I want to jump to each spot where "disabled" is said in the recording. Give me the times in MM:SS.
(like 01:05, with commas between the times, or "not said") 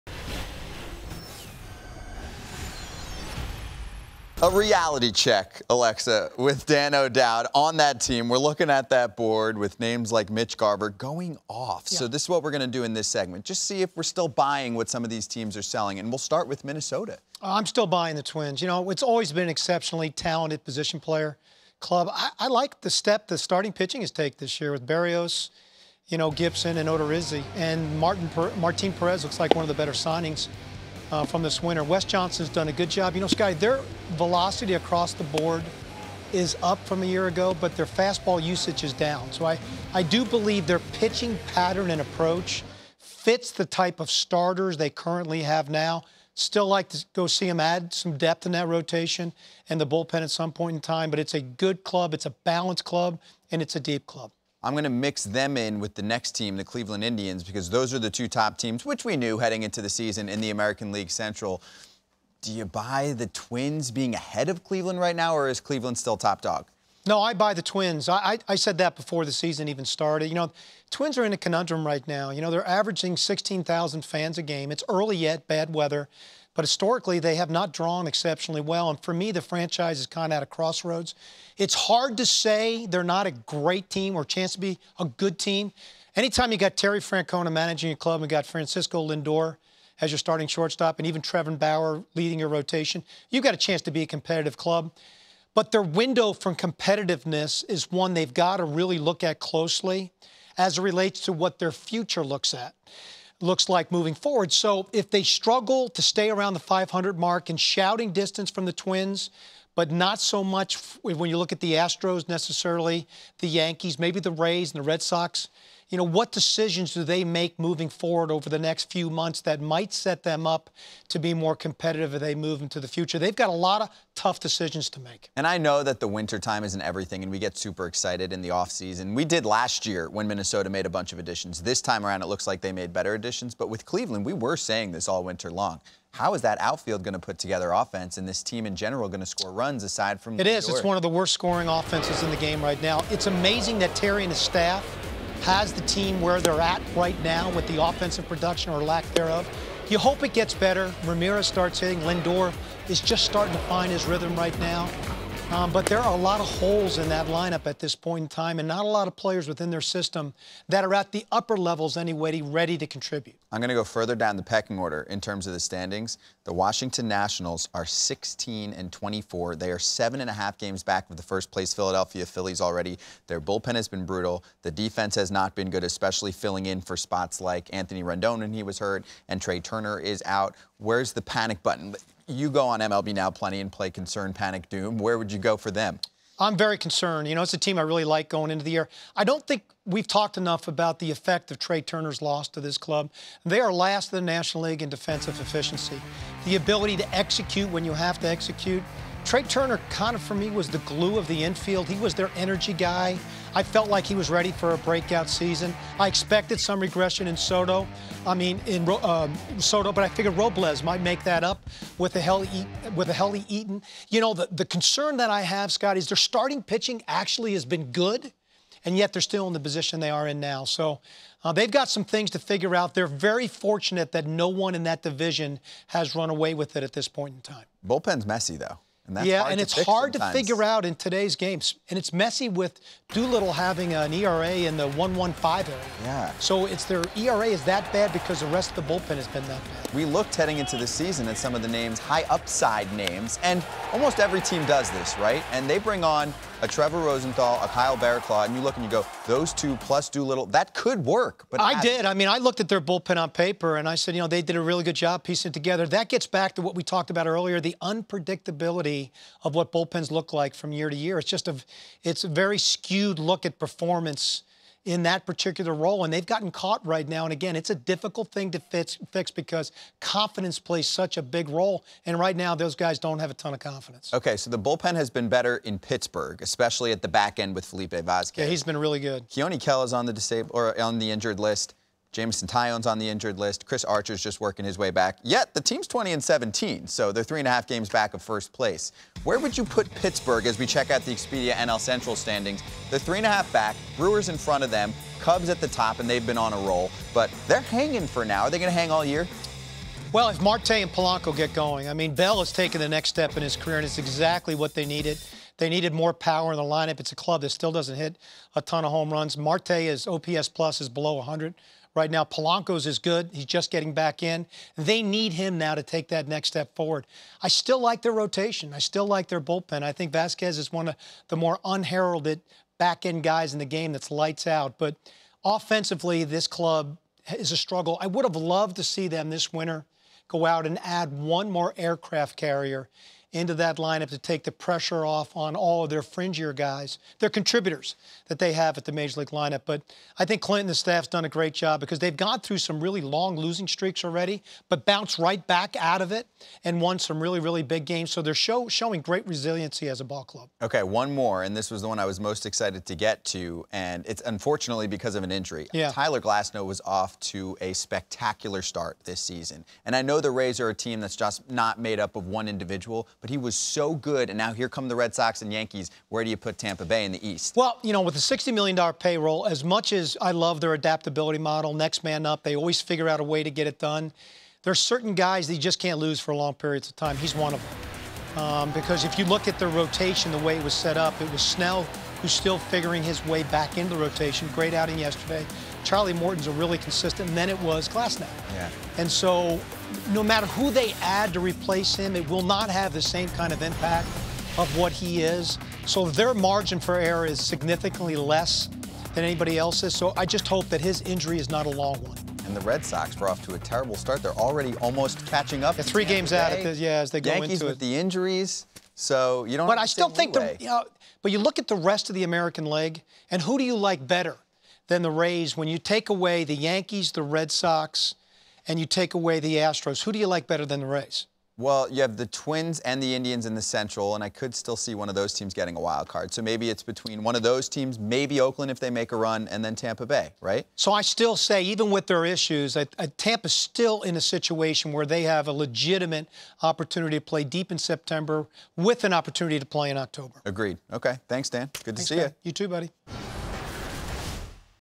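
04:40.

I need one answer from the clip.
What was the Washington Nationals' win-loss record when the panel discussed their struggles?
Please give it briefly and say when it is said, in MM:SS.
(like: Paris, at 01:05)
16 and 24, at 02:47.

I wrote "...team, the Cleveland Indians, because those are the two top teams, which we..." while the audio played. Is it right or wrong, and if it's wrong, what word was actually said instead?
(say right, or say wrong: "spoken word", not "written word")
right.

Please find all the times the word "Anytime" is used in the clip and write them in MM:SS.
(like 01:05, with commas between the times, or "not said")
01:26.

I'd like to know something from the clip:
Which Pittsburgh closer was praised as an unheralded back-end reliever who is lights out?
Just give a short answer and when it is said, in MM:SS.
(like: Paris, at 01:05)
Felipe Vasquez, at 04:37.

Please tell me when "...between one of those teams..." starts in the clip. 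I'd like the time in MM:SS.
07:06.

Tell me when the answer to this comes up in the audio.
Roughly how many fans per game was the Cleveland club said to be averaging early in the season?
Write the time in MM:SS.
01:13.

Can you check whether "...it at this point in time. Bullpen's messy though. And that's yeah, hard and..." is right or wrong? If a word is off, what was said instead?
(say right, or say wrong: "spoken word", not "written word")
right.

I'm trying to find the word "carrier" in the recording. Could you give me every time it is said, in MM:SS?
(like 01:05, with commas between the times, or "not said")
05:32.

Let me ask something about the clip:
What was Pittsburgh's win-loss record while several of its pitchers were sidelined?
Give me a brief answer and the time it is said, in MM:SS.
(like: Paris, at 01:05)
20 and 17, at 04:45.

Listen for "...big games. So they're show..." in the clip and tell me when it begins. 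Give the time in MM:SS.
05:47.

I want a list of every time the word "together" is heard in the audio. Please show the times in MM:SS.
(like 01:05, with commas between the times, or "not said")
02:17, 04:15.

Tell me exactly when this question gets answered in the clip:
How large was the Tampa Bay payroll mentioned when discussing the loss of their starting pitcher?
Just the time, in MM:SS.
06:08.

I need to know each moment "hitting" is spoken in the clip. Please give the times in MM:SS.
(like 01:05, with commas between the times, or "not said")
02:31.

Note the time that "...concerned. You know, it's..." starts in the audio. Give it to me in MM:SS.
03:06.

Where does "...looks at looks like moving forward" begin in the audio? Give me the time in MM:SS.
01:42.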